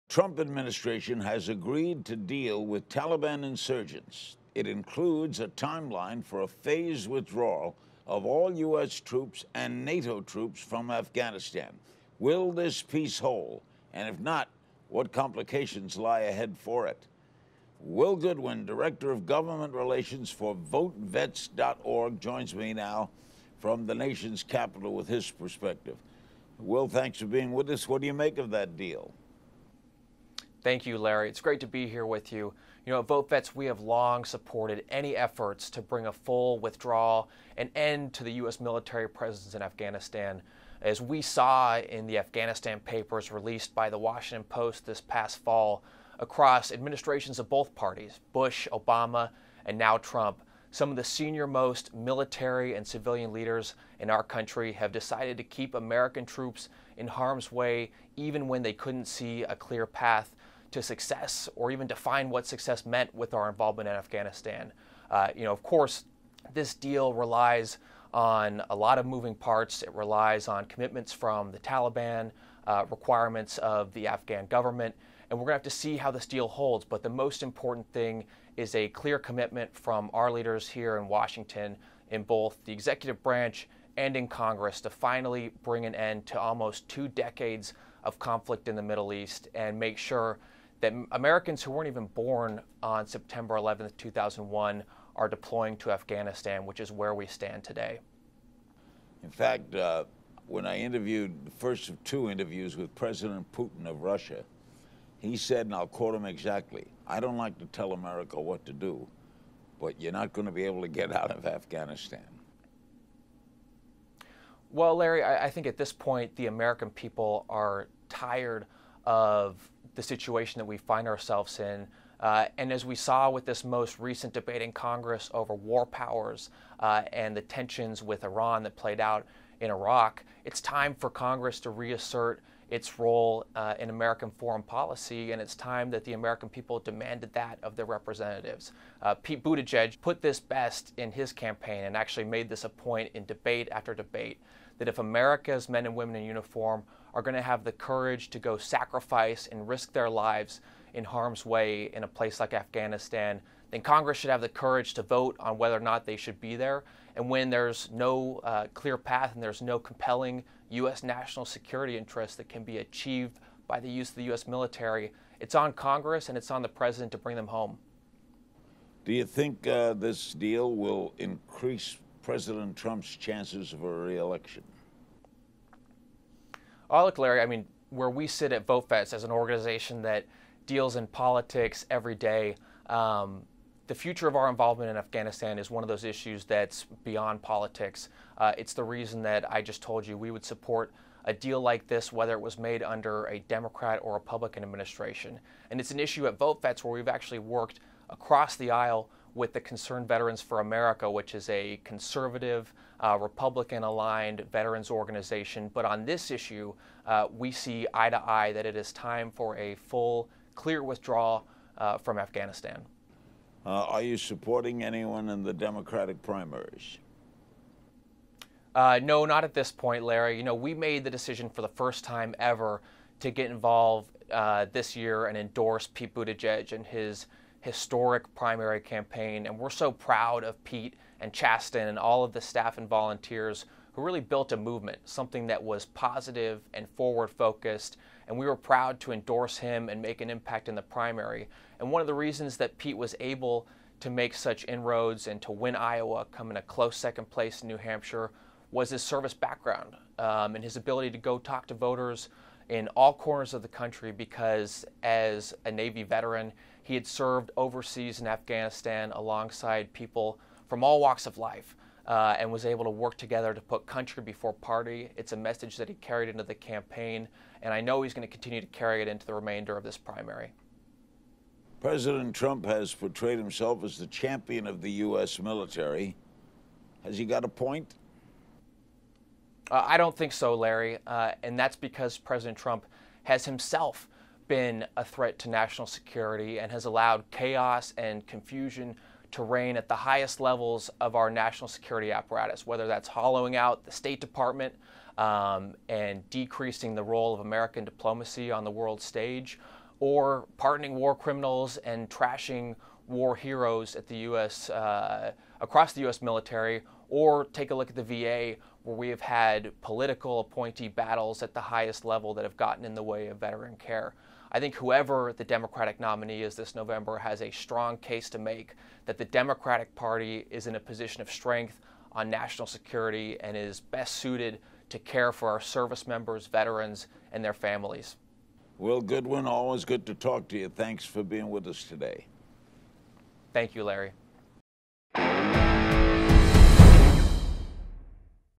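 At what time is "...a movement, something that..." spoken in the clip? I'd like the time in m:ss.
3:54.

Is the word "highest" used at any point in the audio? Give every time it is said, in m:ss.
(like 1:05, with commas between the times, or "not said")
4:49, 5:11.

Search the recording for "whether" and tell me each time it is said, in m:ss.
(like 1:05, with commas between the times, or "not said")
2:35, 3:12, 4:52.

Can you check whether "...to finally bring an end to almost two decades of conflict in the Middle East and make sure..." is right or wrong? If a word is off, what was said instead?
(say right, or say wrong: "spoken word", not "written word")
right.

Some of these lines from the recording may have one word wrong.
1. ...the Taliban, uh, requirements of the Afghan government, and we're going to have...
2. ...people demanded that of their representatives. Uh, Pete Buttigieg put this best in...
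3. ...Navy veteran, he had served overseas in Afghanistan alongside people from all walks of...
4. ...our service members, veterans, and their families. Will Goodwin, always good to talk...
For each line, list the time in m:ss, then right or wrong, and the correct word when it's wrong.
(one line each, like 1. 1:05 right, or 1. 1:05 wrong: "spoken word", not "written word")
1. 1:11 right
2. 2:16 right
3. 4:15 right
4. 5:25 right.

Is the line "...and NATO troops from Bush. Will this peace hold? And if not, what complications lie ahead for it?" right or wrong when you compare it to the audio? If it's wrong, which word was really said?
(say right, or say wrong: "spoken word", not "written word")
wrong: "Afghanistan", not "Bush".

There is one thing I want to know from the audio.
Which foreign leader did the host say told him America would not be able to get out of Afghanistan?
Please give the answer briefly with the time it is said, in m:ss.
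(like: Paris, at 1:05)
Putin, at 1:42.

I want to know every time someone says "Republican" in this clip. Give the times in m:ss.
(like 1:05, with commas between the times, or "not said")
3:14, 3:23.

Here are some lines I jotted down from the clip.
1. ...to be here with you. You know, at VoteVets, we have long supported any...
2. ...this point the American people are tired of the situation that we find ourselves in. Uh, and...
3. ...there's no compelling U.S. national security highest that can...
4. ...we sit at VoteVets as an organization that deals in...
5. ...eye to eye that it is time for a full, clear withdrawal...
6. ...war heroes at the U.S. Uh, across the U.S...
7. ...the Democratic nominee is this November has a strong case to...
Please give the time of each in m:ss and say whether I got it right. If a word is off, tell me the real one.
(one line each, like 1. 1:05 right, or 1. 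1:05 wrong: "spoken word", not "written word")
1. 0:31 right
2. 1:55 right
3. 2:39 wrong: "interest", not "highest"
4. 2:58 right
5. 3:27 right
6. 5:03 right
7. 5:15 right.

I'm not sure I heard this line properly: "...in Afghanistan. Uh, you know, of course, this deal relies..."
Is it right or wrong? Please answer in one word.
right.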